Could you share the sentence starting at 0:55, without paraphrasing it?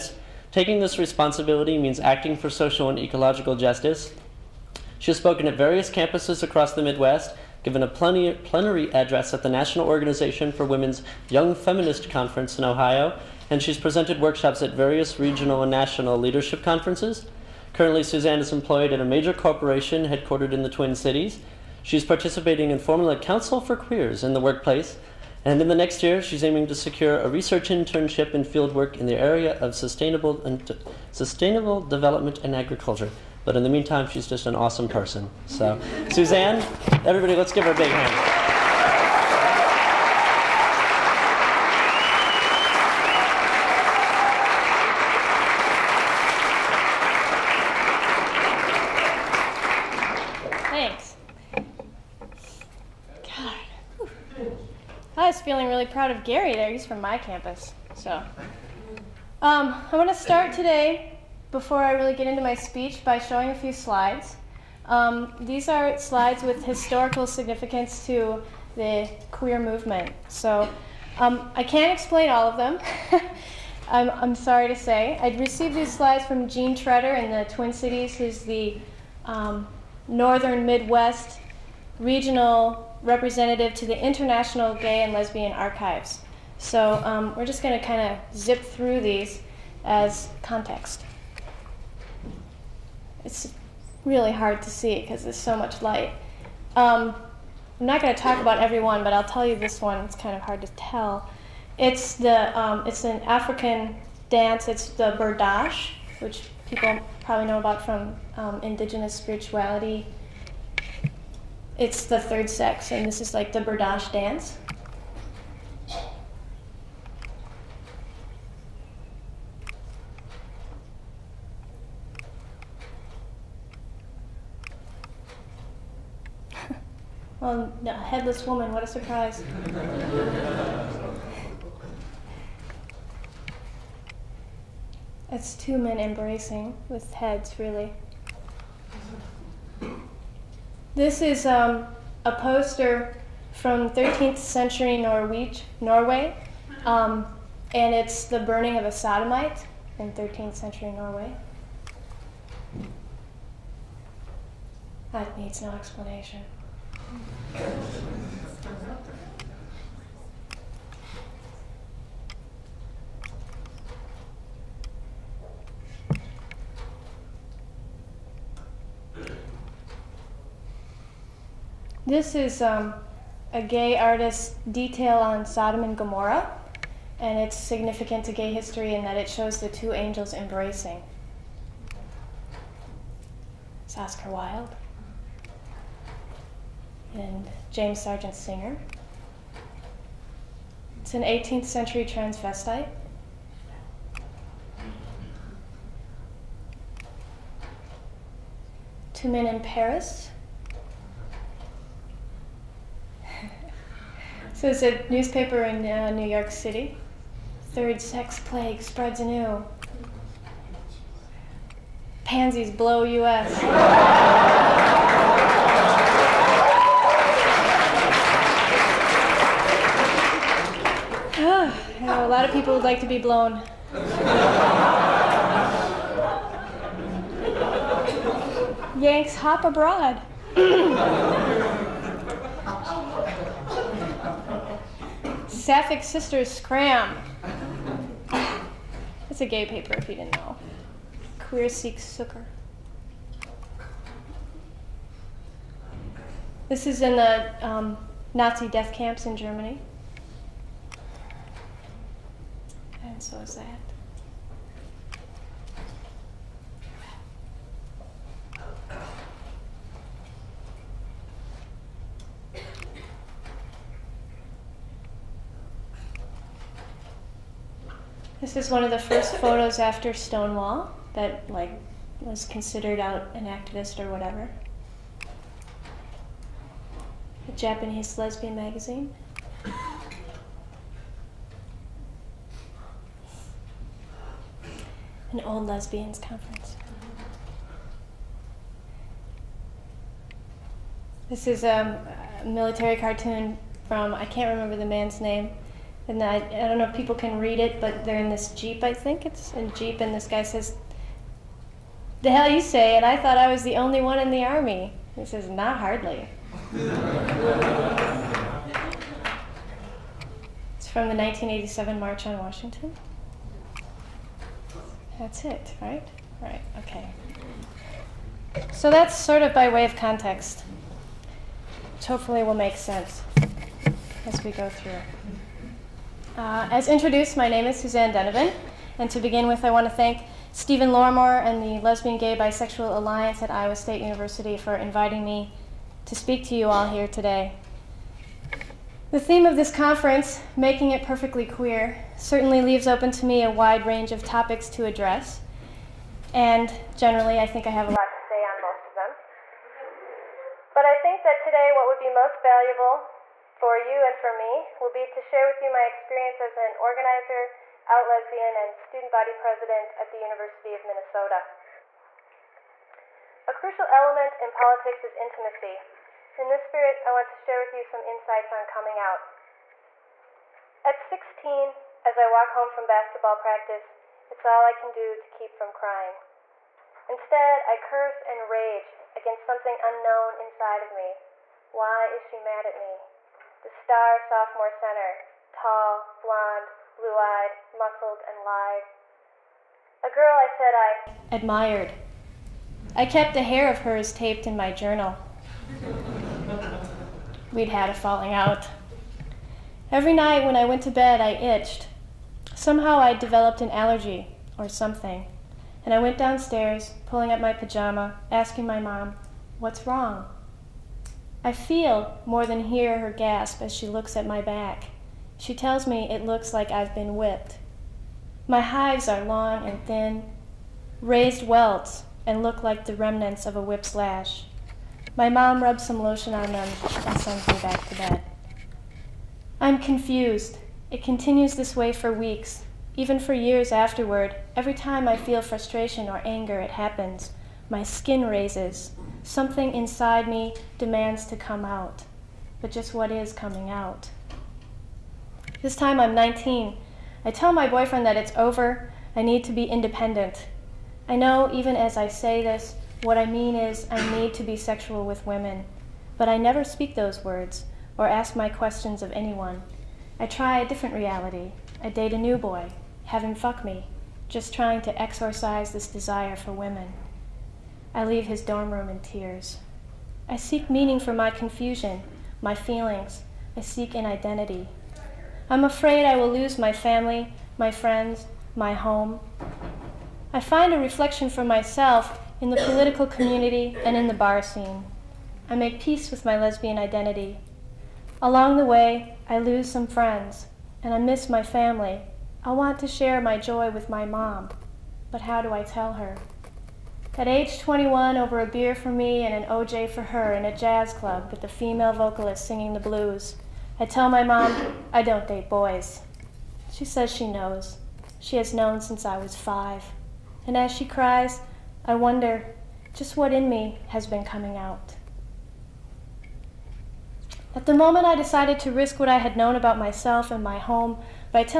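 I was feeling really proud of Gary there.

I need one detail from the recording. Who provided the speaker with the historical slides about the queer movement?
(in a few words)
Jean Tretter.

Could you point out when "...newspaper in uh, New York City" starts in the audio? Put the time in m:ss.
3:25.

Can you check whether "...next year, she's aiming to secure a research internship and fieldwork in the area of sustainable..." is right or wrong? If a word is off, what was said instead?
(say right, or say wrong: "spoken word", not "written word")
right.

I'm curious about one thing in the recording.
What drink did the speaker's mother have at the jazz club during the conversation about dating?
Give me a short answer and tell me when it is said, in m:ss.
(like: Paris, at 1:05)
OJ, at 8:19.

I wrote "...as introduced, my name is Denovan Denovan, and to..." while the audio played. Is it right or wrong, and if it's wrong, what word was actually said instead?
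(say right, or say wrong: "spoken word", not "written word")
wrong: "Suzanne", not "Denovan".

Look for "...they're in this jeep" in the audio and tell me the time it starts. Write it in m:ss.
4:58.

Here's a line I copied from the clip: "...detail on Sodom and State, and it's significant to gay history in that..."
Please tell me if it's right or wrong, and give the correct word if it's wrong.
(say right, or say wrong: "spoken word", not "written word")
wrong: "Gomorrah", not "State".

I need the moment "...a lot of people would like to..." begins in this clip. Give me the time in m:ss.
3:42.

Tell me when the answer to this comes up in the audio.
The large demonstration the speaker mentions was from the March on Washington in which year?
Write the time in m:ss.
5:11.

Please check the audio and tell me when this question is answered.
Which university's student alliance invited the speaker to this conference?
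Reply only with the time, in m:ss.
5:33.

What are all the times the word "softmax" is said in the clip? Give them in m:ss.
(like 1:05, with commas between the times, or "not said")
not said.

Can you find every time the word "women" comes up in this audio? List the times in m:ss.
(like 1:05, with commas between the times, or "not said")
0:10, 7:35, 7:46.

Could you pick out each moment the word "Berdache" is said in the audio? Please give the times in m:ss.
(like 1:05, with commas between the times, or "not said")
1:45, 1:53.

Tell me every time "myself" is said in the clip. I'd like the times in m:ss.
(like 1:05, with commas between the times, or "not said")
8:01, 8:39.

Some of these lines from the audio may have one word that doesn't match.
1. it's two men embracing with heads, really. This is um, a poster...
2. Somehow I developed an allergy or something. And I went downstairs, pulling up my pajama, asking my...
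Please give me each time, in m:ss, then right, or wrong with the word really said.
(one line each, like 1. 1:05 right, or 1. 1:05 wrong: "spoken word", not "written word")
1. 2:15 right
2. 6:42 right.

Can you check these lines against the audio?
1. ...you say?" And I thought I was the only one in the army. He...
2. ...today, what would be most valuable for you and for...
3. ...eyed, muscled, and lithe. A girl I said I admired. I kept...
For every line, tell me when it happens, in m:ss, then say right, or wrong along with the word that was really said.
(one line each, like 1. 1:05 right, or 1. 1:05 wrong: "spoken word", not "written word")
1. 5:02 right
2. 5:51 right
3. 6:27 right.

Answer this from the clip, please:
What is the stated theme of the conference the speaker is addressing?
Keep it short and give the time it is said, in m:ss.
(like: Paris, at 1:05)
Making It Perfectly Queer, at 5:40.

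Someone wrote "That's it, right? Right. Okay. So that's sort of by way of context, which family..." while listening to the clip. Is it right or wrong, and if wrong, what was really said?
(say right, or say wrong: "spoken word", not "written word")
wrong: "hopefully", not "family".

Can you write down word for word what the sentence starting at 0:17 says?
Currently, Suzanne is employed at a major corporation headquartered in the Twin Cities.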